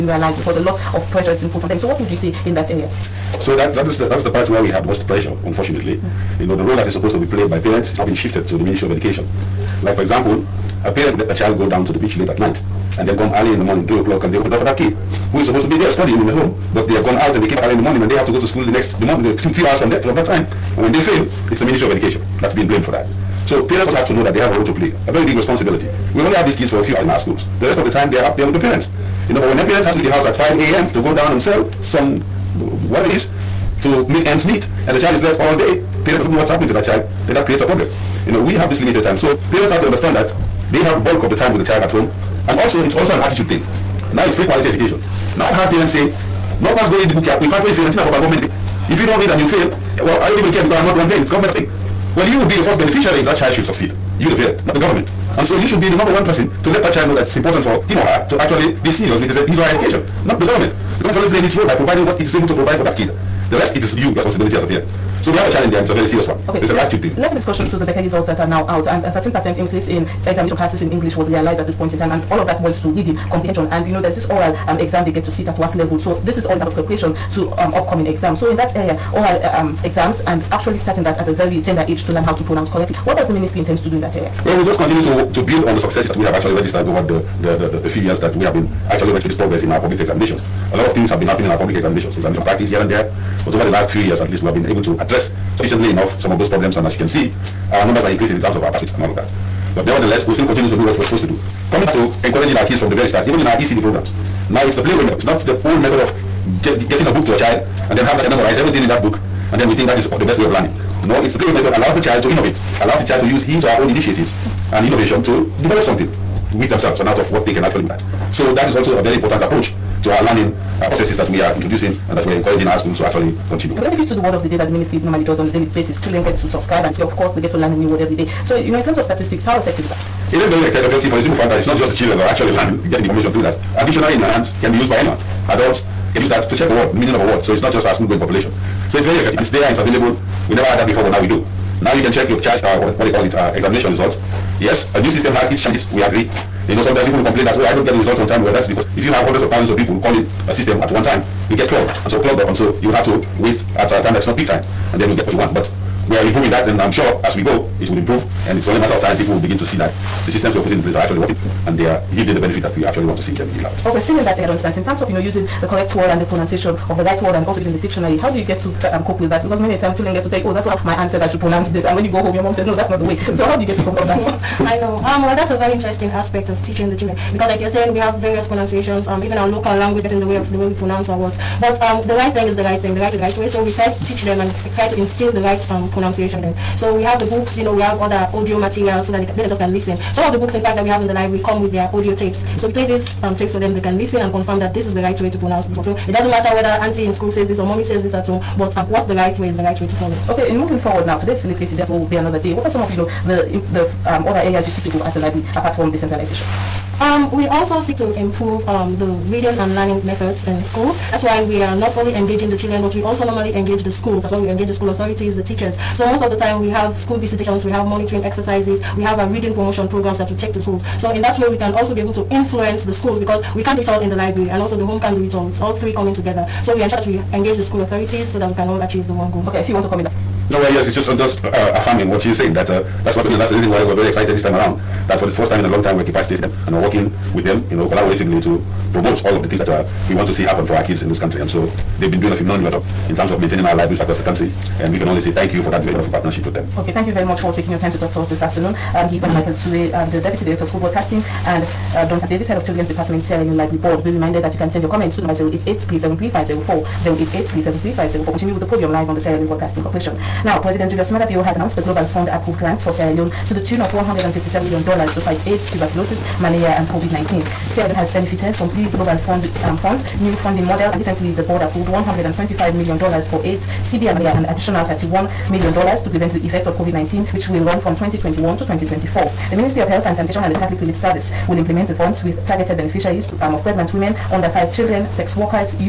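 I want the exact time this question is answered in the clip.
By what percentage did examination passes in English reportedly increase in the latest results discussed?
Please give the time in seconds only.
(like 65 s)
69 s.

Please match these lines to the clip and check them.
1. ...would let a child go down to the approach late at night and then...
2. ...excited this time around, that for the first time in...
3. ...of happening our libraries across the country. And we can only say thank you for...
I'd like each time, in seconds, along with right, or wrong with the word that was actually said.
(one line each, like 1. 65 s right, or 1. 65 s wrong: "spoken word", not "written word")
1. 11 s wrong: "beach", not "approach"
2. 234 s right
3. 243 s wrong: "maintaining", not "happening".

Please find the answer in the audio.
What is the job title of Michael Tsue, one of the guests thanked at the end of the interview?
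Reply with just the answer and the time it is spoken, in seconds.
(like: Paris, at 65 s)
Deputy Director of School Broadcasting, at 250 s.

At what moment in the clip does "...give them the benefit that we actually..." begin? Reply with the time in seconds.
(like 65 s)
162 s.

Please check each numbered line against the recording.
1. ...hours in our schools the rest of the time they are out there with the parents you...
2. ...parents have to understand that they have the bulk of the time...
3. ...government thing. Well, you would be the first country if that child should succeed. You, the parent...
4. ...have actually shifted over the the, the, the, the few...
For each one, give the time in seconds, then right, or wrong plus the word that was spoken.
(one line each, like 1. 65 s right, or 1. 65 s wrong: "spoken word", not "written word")
1. 26 s right
2. 39 s right
3. 51 s wrong: "beneficiary", not "country"
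4. 86 s wrong: "registered", not "shifted".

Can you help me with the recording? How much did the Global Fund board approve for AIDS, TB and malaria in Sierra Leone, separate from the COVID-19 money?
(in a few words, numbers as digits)
$125 million.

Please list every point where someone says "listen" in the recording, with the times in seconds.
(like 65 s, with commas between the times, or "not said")
189 s, 193 s.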